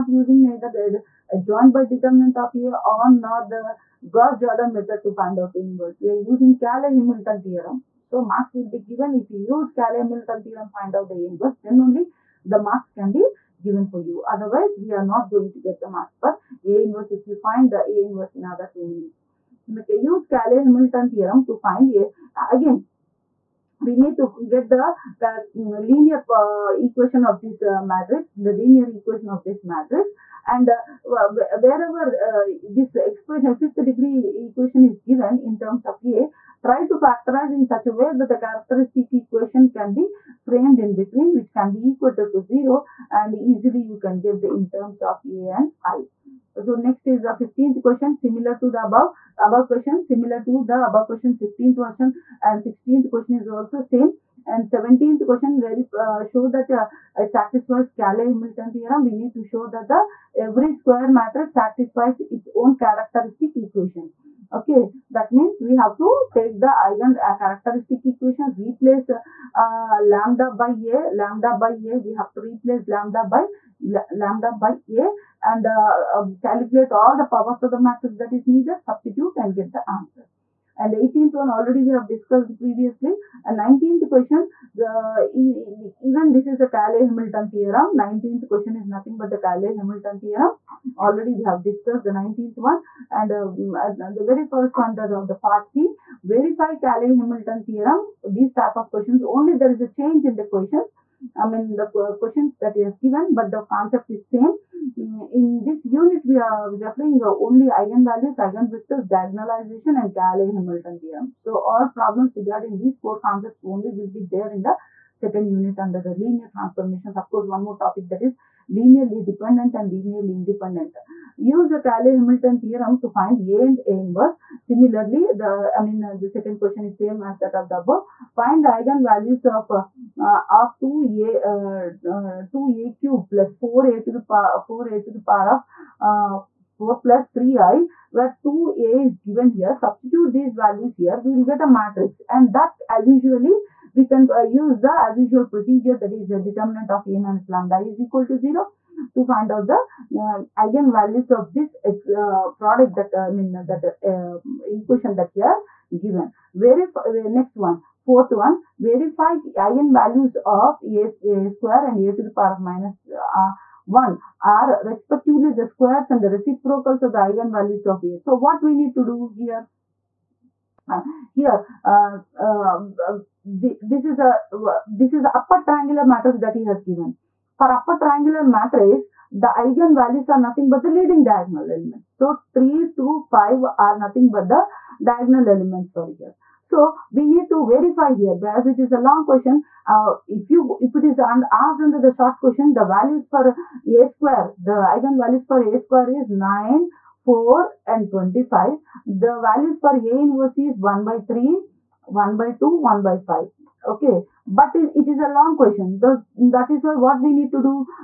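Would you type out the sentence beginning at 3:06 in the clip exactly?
So we need to verify here because it is a long question.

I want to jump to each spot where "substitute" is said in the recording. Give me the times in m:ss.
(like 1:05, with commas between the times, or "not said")
1:18, 2:19.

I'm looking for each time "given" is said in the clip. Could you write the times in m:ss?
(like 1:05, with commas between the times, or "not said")
0:08, 0:13, 0:35, 1:42, 2:19, 2:36, 2:56.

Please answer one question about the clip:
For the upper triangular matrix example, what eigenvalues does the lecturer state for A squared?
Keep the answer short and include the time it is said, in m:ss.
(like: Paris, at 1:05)
9, 4 and 25, at 3:16.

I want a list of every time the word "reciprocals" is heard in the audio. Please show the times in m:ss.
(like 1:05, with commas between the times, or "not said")
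2:46.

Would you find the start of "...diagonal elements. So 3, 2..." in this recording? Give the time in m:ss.
3:01.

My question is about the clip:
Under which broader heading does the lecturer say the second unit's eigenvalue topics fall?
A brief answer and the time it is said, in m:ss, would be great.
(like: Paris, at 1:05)
Linear transformations, at 1:56.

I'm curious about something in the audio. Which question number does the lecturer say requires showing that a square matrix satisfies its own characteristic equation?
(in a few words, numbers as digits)
17.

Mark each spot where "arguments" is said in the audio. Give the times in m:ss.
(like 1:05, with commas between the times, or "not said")
not said.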